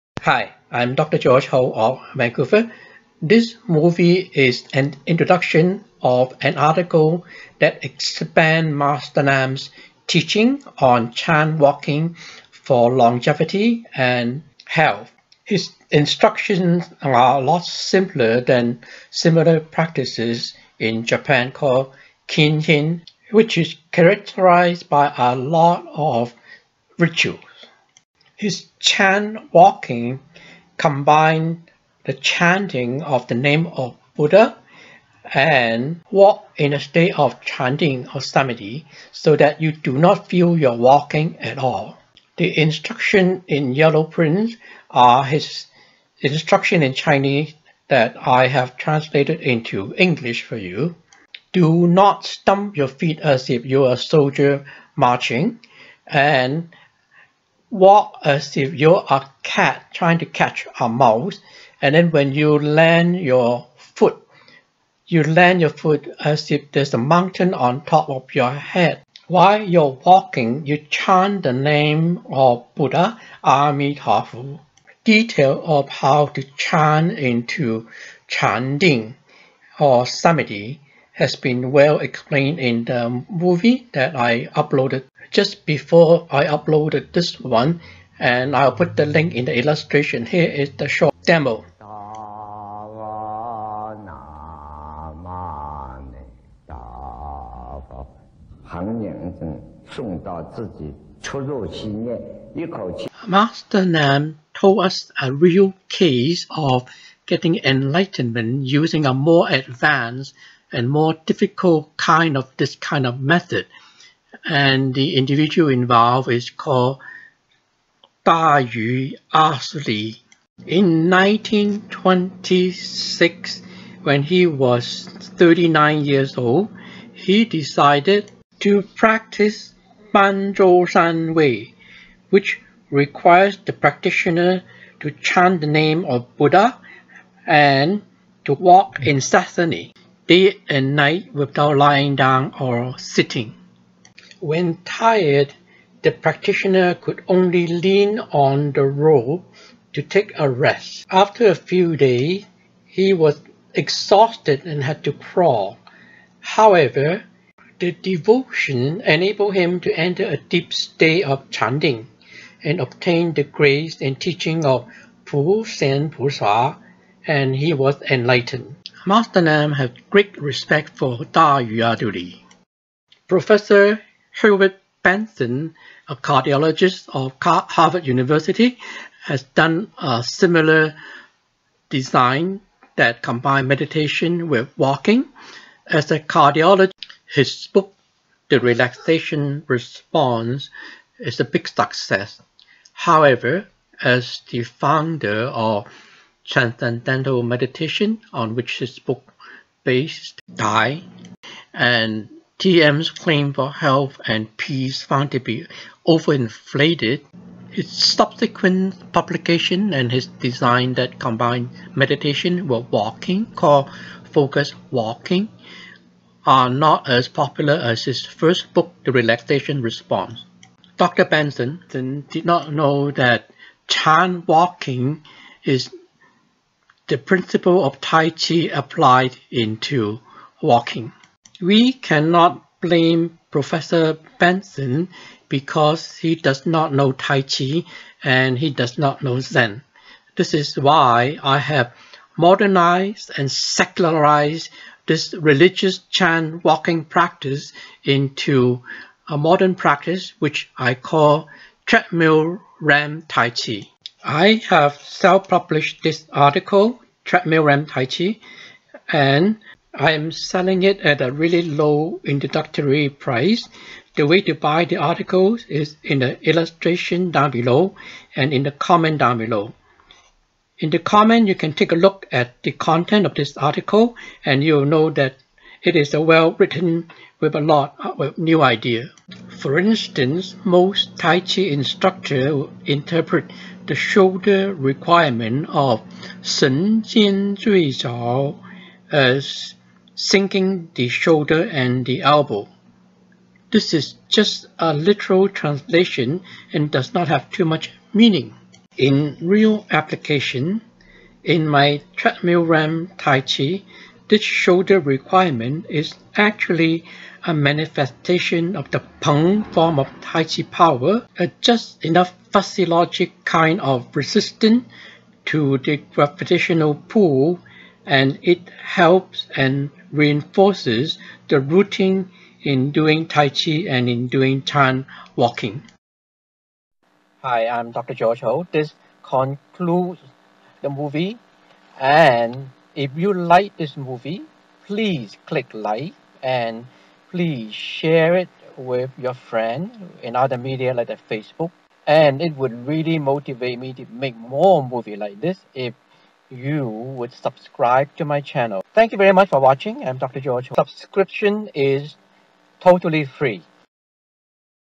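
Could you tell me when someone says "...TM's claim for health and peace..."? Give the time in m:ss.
3:22.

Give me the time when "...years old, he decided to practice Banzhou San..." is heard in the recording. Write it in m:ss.
2:06.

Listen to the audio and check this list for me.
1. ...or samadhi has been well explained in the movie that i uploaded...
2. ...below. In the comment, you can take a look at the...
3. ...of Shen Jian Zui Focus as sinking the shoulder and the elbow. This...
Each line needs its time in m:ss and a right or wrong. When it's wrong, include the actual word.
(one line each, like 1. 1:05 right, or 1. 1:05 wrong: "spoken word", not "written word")
1. 1:19 right
2. 4:29 right
3. 4:45 wrong: "Zhao", not "Focus".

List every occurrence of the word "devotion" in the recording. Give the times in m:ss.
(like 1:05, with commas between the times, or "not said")
2:37.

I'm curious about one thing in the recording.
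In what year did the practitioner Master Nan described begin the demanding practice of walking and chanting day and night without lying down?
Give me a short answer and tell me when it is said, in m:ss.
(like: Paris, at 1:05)
1926, at 2:01.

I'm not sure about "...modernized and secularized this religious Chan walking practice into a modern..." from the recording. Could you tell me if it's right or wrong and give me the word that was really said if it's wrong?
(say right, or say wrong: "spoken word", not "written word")
right.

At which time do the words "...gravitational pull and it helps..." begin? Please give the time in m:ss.
5:16.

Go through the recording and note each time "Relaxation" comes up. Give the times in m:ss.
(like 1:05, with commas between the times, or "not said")
3:08, 3:39.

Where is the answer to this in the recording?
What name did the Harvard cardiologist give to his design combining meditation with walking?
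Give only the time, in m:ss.
3:34.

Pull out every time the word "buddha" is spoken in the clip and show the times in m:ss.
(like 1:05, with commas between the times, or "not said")
0:34, 1:12, 2:16.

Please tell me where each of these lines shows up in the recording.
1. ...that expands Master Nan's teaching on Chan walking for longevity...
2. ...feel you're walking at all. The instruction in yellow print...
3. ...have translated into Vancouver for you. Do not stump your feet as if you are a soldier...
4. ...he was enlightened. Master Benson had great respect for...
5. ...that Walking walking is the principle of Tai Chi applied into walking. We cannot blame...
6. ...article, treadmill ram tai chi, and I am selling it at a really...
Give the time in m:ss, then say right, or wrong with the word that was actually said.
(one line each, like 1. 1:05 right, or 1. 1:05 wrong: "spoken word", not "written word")
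1. 0:07 right
2. 0:40 right
3. 0:48 wrong: "English", not "Vancouver"
4. 2:47 wrong: "Nan", not "Benson"
5. 3:43 wrong: "Chan", not "Walking"
6. 4:16 right.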